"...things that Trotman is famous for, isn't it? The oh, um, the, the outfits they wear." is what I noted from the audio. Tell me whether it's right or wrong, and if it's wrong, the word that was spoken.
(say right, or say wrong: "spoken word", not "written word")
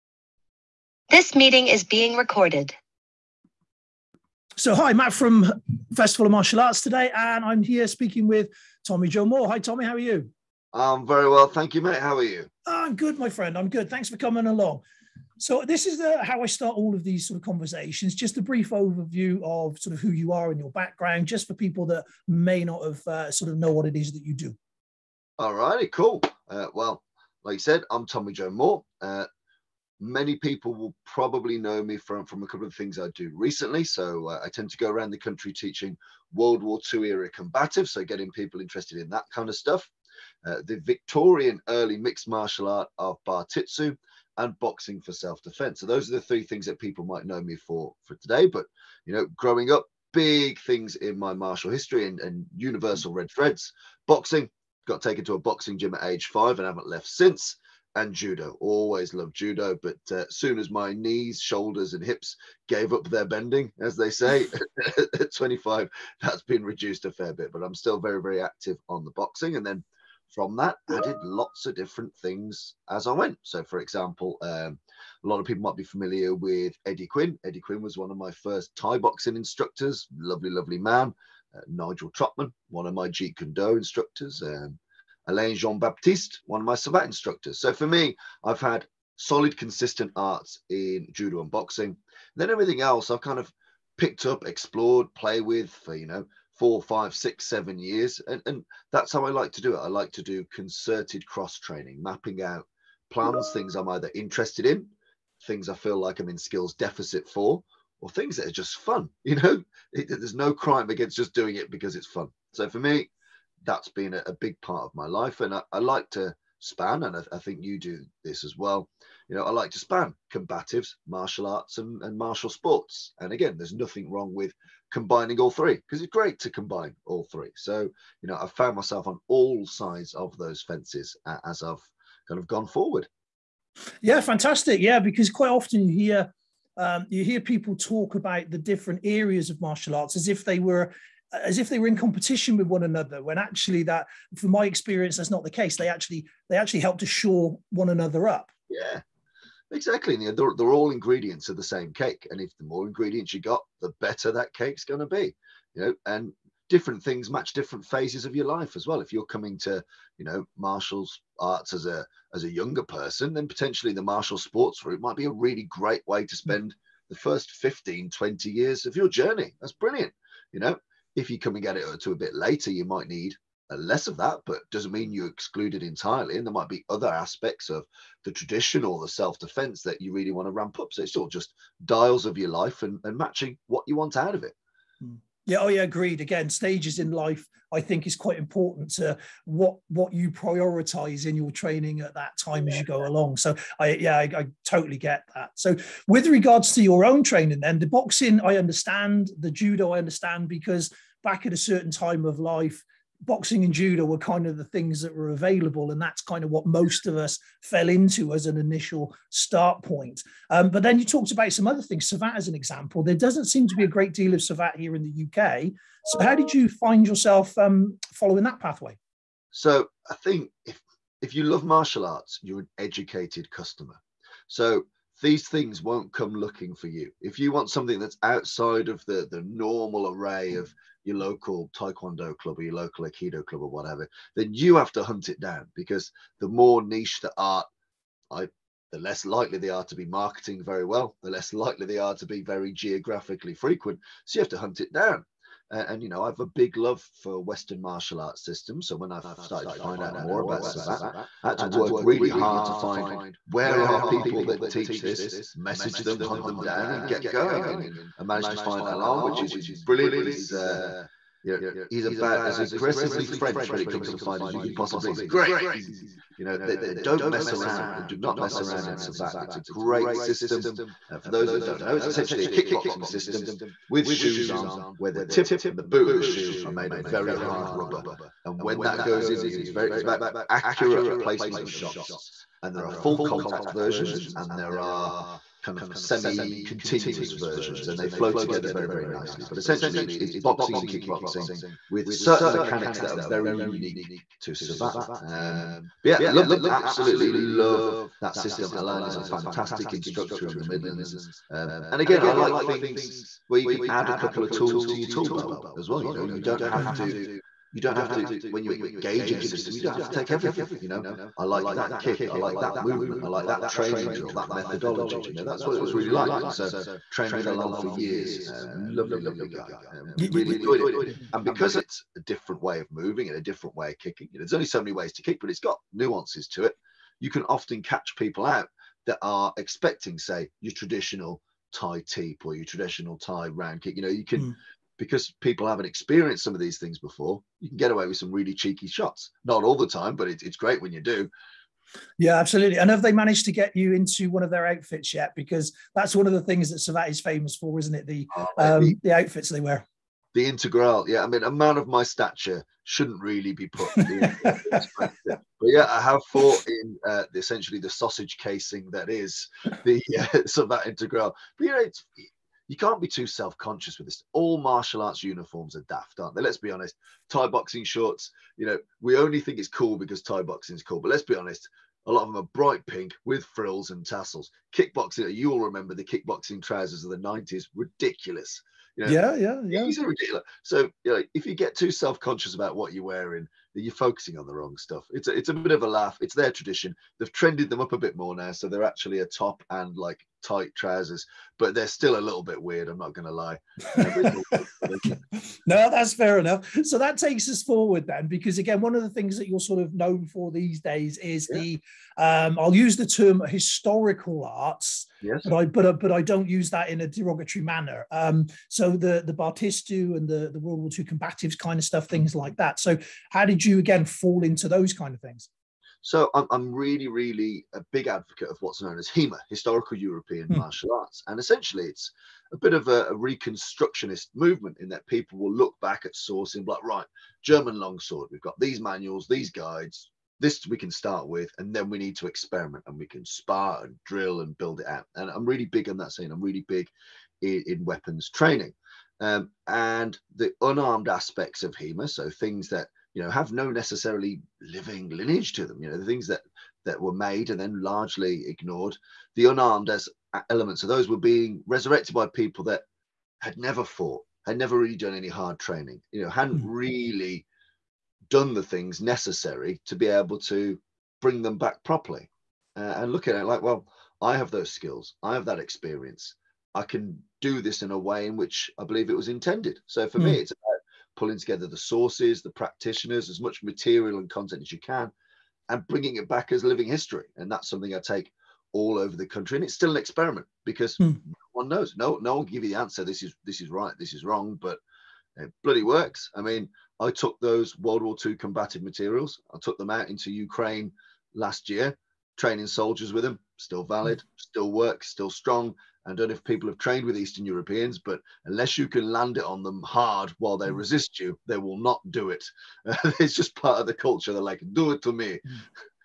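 wrong: "Savate", not "Trotman".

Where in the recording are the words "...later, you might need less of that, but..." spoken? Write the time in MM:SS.
02:52.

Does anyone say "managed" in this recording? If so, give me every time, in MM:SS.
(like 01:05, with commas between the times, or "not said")
04:18, 05:43.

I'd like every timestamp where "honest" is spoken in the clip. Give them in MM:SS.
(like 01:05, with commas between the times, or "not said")
06:06, 06:11.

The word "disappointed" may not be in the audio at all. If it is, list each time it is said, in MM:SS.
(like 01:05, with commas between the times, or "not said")
not said.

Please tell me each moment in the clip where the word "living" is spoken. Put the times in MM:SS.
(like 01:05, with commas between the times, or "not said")
07:24, 07:56.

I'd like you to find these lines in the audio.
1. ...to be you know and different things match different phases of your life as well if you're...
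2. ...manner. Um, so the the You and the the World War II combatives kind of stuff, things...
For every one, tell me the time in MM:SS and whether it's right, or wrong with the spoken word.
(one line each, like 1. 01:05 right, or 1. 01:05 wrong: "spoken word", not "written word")
1. 02:34 right
2. 06:47 wrong: "Bartitsu", not "You".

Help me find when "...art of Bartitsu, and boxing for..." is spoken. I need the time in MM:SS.
00:42.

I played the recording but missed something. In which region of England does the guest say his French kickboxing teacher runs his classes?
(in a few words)
the Midlands.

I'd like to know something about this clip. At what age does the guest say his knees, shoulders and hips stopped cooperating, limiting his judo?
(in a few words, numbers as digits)
25.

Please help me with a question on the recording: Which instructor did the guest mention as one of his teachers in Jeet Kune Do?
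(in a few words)
Nigel Trotman.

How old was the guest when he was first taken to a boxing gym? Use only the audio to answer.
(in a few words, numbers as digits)
5.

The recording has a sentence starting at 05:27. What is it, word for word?
You can often catch people out that are expecting, say, your traditional Thai teep or your traditional Thai round kick.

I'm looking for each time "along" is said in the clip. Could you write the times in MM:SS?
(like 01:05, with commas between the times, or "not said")
00:14, 03:13.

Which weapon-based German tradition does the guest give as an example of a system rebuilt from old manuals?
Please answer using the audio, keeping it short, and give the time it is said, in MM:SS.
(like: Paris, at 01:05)
German longsword, at 07:07.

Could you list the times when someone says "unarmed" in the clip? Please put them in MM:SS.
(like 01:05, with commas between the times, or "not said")
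07:20, 07:29.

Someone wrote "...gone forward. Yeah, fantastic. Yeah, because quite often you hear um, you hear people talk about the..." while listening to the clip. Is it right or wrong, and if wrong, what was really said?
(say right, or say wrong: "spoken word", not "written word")
right.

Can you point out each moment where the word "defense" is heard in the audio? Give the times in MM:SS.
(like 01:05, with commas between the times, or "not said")
00:45, 02:59.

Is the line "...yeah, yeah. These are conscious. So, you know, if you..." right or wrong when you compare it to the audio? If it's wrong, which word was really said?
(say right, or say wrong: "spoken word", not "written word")
wrong: "ridiculous", not "conscious".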